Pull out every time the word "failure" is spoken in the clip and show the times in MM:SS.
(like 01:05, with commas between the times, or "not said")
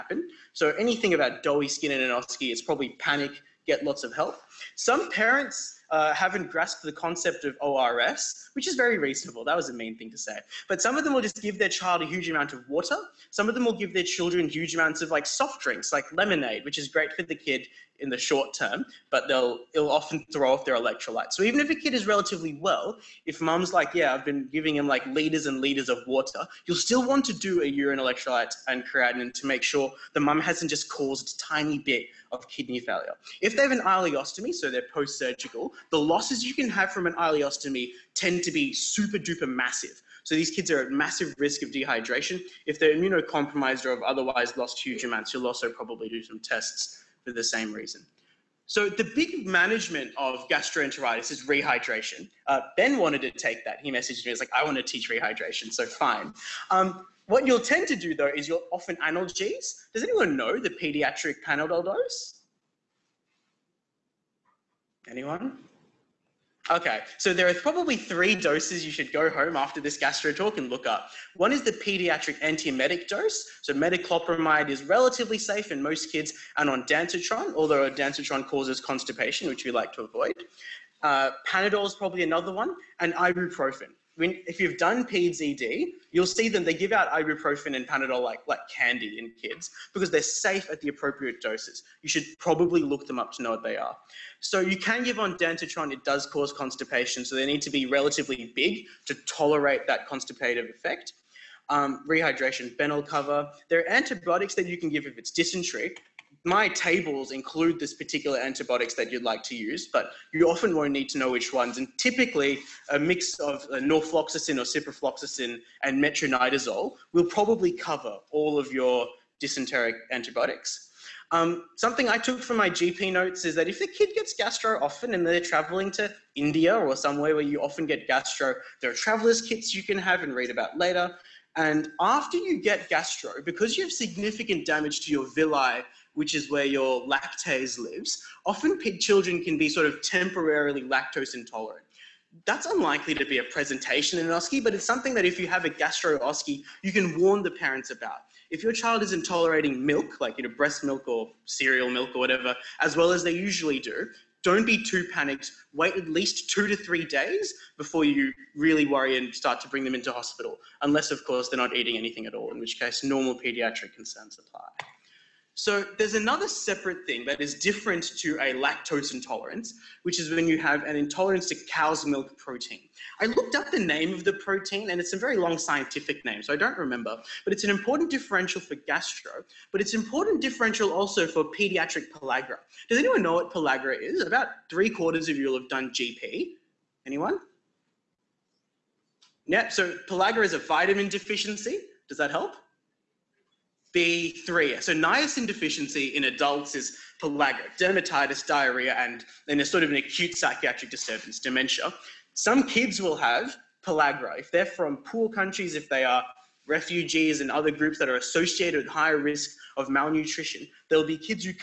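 00:32.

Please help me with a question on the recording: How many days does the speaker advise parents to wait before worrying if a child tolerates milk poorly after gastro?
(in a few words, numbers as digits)
2 to 3 days.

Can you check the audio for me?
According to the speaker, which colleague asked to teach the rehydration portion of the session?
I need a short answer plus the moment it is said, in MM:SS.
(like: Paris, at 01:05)
Ben, at 00:52.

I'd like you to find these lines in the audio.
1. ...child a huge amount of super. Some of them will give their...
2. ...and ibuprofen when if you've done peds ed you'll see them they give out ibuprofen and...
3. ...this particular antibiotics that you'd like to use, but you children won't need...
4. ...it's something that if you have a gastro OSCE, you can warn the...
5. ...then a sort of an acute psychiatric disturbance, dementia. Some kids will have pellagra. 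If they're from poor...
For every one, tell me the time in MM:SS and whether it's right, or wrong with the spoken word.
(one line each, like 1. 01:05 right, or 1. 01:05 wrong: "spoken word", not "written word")
1. 00:11 wrong: "water", not "super"
2. 01:22 right
3. 01:47 wrong: "often", not "children"
4. 02:24 right
5. 03:19 right.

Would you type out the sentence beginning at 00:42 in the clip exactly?
If they're immunocompromised or have otherwise lost huge amounts, you'll also probably do some tests for the same reason.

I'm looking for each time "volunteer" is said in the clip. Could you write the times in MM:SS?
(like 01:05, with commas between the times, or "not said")
not said.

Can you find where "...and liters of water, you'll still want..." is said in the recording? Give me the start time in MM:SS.
00:25.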